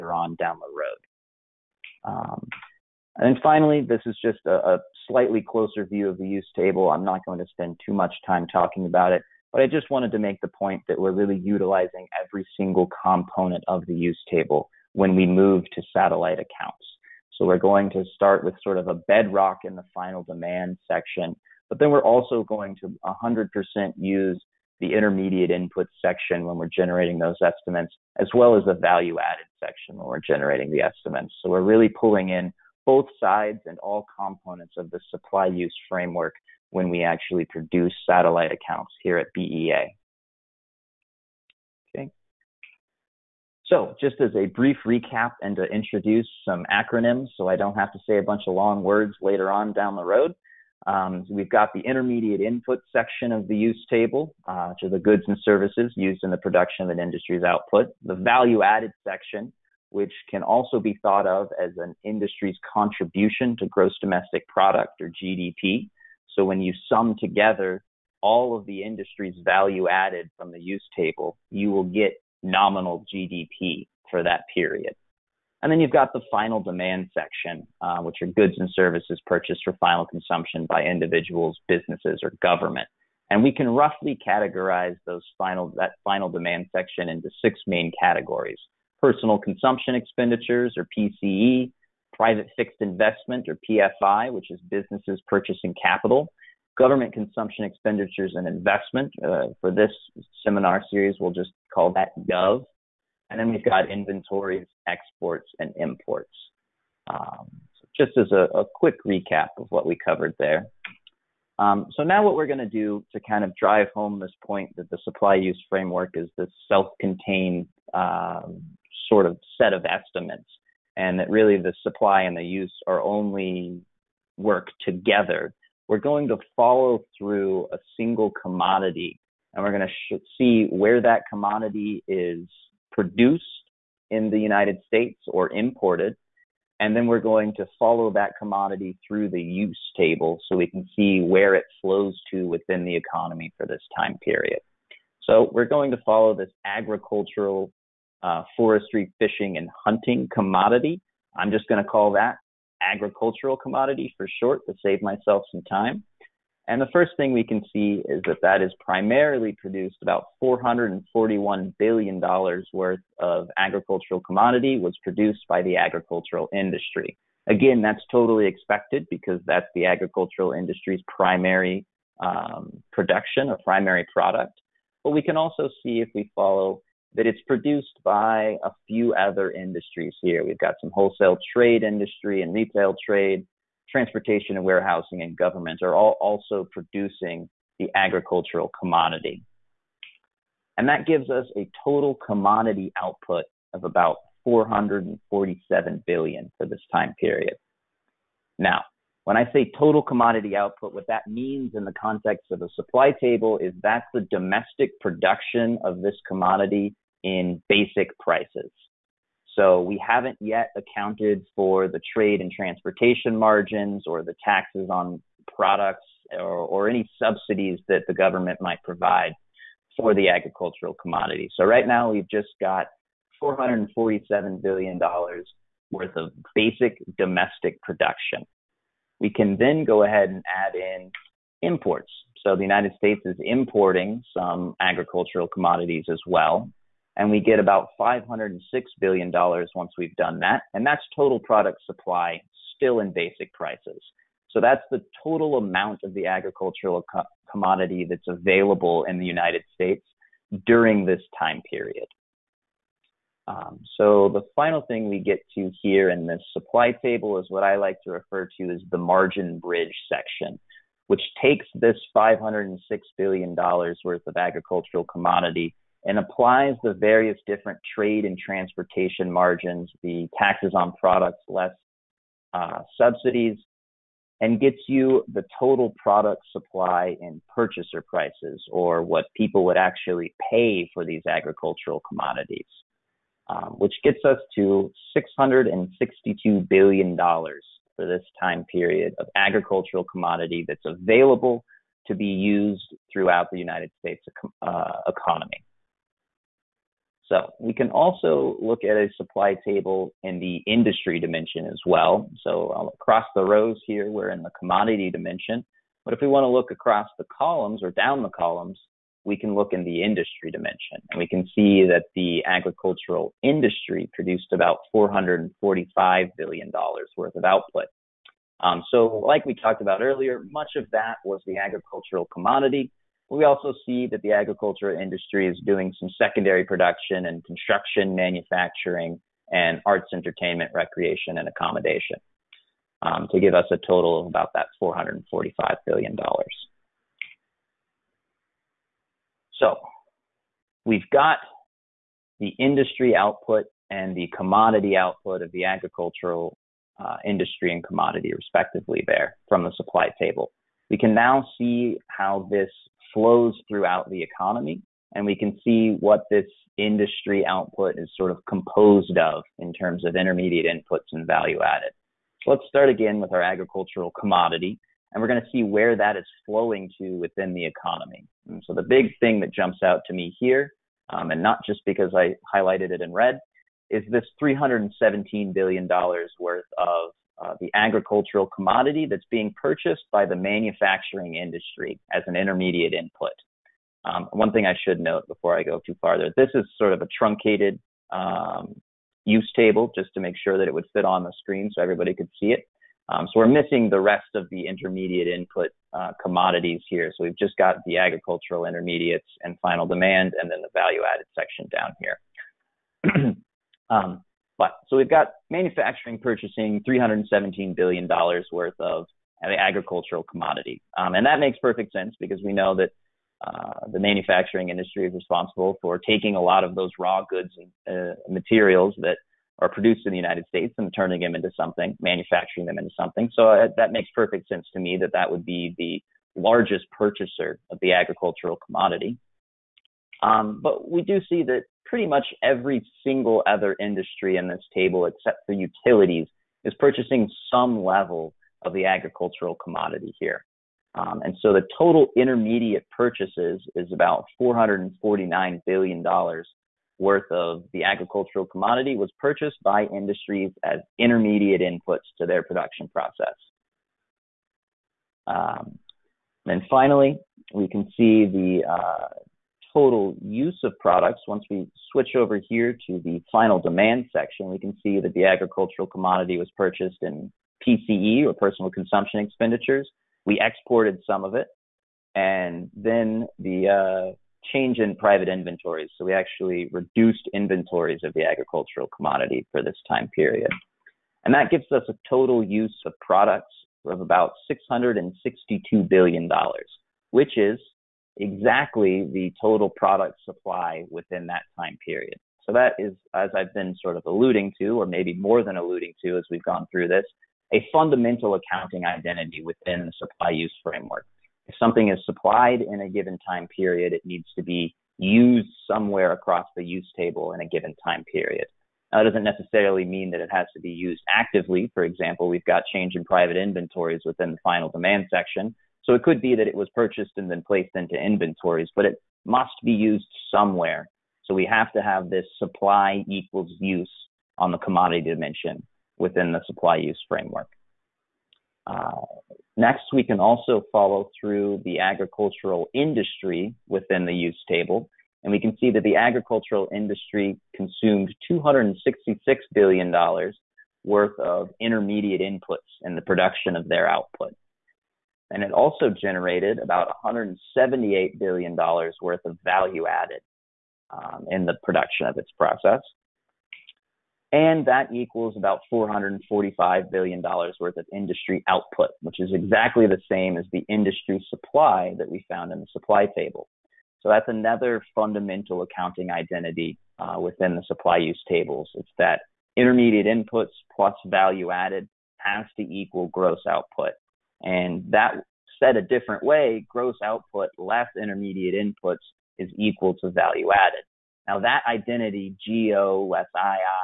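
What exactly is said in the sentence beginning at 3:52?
So the United States is importing some agricultural commodities as well.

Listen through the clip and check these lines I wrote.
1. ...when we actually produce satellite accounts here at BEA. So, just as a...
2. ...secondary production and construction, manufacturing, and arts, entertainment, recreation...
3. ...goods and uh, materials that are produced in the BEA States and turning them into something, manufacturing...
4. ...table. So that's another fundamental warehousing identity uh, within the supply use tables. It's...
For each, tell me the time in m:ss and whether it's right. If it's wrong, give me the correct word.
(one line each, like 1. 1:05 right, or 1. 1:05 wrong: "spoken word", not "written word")
1. 0:36 right
2. 5:26 right
3. 6:57 wrong: "United", not "BEA"
4. 9:23 wrong: "accounting", not "warehousing".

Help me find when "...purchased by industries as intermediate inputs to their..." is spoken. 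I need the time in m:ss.
7:29.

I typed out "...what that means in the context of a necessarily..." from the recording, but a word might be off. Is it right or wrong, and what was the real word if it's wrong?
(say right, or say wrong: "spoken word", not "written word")
wrong: "supply", not "necessarily".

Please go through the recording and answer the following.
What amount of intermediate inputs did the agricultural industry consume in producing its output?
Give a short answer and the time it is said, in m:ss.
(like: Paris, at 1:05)
$266 billion, at 8:58.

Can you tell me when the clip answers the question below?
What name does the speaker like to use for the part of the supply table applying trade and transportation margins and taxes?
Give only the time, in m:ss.
4:18.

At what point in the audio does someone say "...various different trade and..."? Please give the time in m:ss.
4:26.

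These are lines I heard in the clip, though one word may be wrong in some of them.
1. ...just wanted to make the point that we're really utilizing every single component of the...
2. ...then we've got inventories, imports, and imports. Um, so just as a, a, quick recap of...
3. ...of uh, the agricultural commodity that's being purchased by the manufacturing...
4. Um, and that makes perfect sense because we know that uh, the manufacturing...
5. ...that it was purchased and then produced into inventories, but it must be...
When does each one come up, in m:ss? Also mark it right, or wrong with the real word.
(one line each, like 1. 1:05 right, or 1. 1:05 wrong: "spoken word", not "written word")
1. 0:09 right
2. 1:43 wrong: "exports", not "imports"
3. 6:16 right
4. 6:50 right
5. 8:36 wrong: "placed", not "produced".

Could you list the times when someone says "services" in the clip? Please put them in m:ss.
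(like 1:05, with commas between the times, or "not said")
0:55, 1:18.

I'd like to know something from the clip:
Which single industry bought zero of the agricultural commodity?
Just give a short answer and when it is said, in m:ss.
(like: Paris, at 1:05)
utilities, at 7:15.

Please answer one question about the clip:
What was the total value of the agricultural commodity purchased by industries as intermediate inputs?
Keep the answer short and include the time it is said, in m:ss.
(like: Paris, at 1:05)
$449 billion, at 7:24.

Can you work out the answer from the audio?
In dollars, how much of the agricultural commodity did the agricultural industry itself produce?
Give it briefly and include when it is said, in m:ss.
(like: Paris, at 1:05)
$441 billion, at 2:40.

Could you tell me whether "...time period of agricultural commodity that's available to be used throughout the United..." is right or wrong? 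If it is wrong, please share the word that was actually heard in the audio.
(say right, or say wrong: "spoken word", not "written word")
right.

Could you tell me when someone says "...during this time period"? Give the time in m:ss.
4:10.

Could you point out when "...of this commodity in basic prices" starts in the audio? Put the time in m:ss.
3:25.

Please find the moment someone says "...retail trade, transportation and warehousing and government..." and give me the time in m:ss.
3:02.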